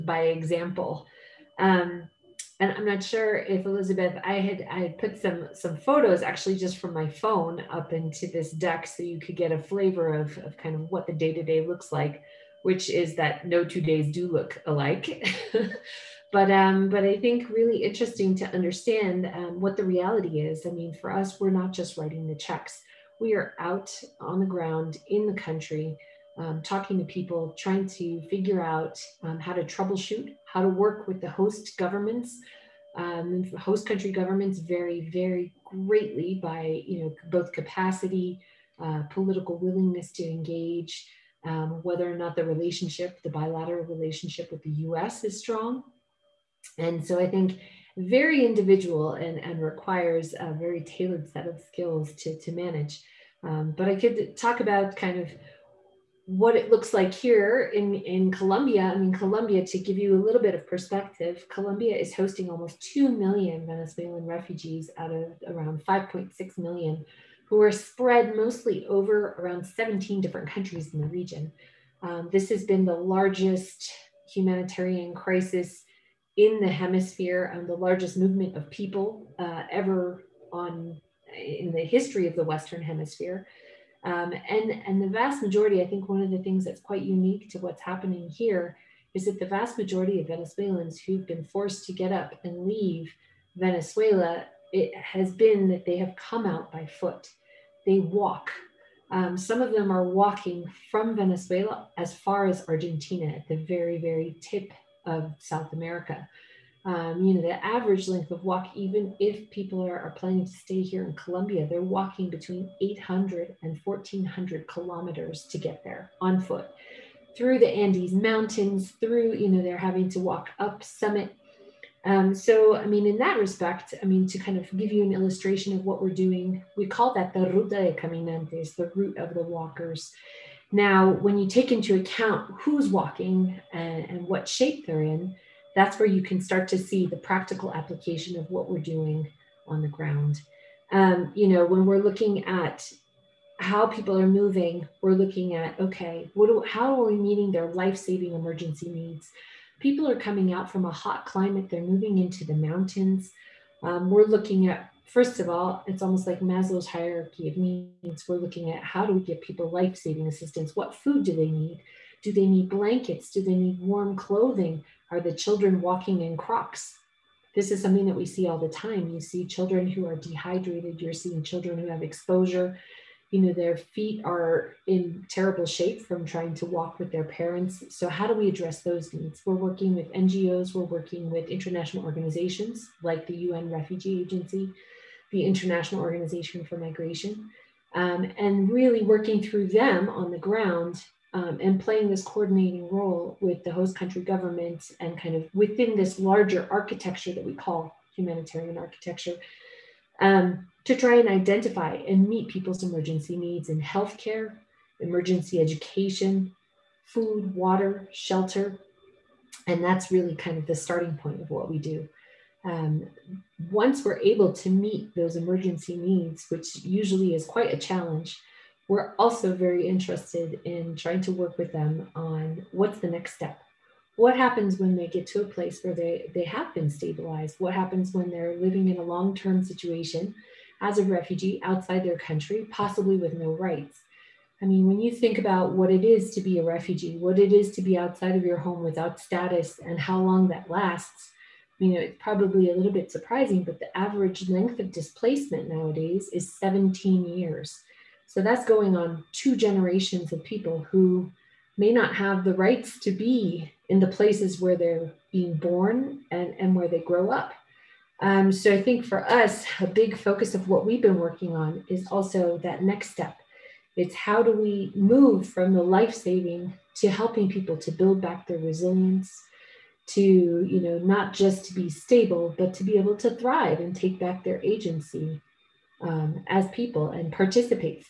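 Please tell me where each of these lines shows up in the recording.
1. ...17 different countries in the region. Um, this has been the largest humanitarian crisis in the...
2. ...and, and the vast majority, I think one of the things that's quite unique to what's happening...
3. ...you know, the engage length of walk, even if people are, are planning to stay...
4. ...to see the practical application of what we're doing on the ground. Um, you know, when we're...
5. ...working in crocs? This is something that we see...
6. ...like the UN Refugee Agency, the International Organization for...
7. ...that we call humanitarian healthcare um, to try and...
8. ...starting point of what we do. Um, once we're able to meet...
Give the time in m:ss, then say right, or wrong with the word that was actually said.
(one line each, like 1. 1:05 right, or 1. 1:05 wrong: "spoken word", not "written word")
1. 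1:09 right
2. 1:24 right
3. 1:47 wrong: "average", not "engage"
4. 2:16 right
5. 2:45 wrong: "walking", not "working"
6. 3:03 right
7. 3:17 wrong: "architecture", not "healthcare"
8. 3:30 right.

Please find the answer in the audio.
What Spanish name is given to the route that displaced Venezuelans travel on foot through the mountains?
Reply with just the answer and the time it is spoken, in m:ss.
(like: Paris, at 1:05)
Ruta de Caminantes, at 2:07.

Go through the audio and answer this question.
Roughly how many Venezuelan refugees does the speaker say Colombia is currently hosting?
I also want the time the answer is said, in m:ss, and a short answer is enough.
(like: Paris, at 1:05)
almost 2 million, at 1:02.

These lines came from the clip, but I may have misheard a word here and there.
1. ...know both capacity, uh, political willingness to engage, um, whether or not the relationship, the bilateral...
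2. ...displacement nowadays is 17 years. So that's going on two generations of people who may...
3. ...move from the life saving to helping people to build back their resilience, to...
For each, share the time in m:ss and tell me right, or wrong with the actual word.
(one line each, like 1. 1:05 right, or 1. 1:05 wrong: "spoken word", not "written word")
1. 0:37 right
2. 4:04 right
3. 4:24 right.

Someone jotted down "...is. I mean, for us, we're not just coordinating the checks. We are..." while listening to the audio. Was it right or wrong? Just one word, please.
wrong.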